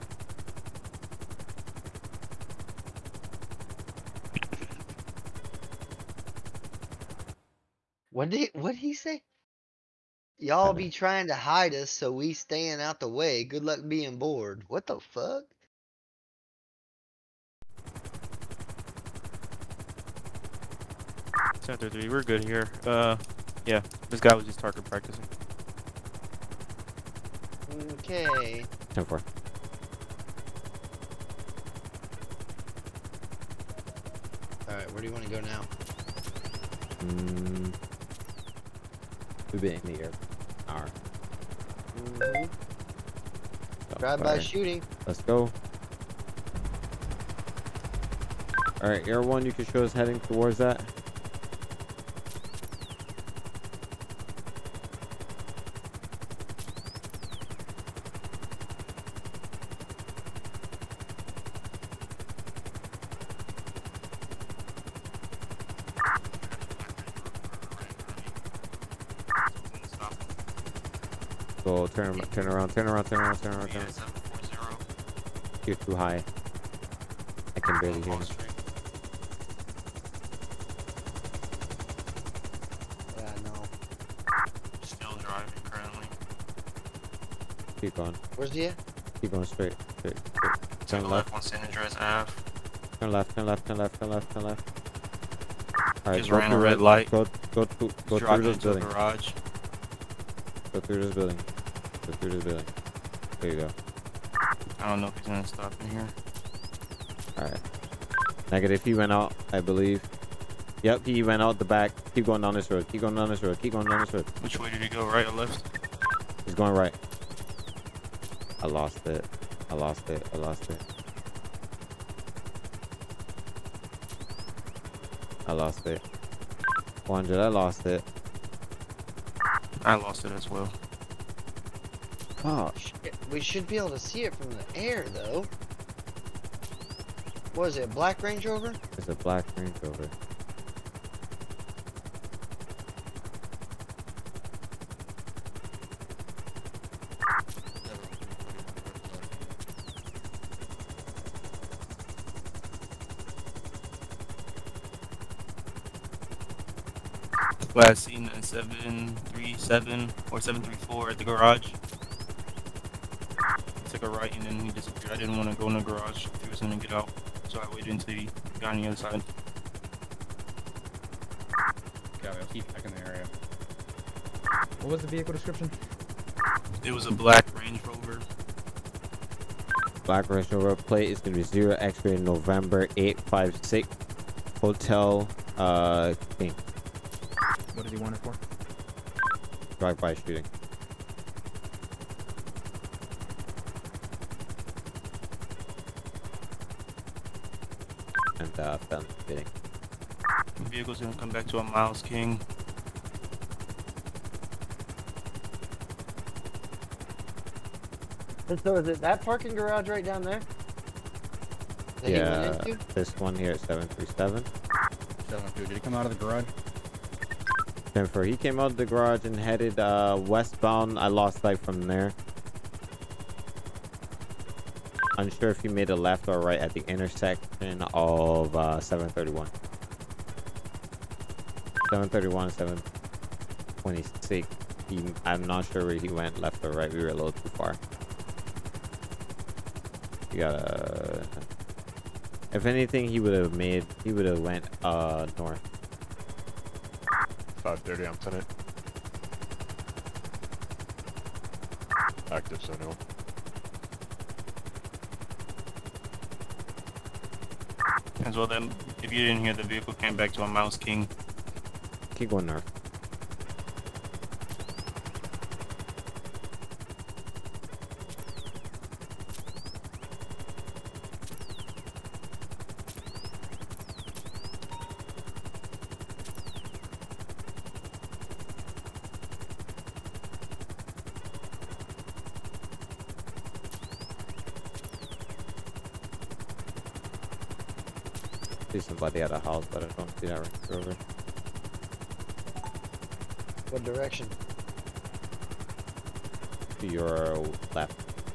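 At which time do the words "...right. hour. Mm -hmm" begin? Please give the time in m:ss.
0:40.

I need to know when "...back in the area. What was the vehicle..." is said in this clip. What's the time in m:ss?
2:52.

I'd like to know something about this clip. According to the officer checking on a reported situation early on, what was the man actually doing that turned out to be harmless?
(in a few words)
target practicing.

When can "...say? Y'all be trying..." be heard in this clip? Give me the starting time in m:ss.
0:08.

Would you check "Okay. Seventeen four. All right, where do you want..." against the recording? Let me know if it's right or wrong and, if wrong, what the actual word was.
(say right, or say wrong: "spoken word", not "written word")
wrong: "Ten", not "Seventeen".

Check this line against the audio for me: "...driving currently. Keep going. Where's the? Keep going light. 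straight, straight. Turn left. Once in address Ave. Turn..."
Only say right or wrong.
wrong.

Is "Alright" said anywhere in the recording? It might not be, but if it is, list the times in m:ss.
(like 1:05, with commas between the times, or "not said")
0:48, 1:36, 1:47.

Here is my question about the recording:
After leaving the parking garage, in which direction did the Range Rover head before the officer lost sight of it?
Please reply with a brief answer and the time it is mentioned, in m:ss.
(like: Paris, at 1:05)
westbound, at 3:40.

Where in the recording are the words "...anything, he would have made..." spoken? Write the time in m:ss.
4:02.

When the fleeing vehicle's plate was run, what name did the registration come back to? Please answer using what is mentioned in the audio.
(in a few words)
Miles King.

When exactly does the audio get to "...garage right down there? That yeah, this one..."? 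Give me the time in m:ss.
3:29.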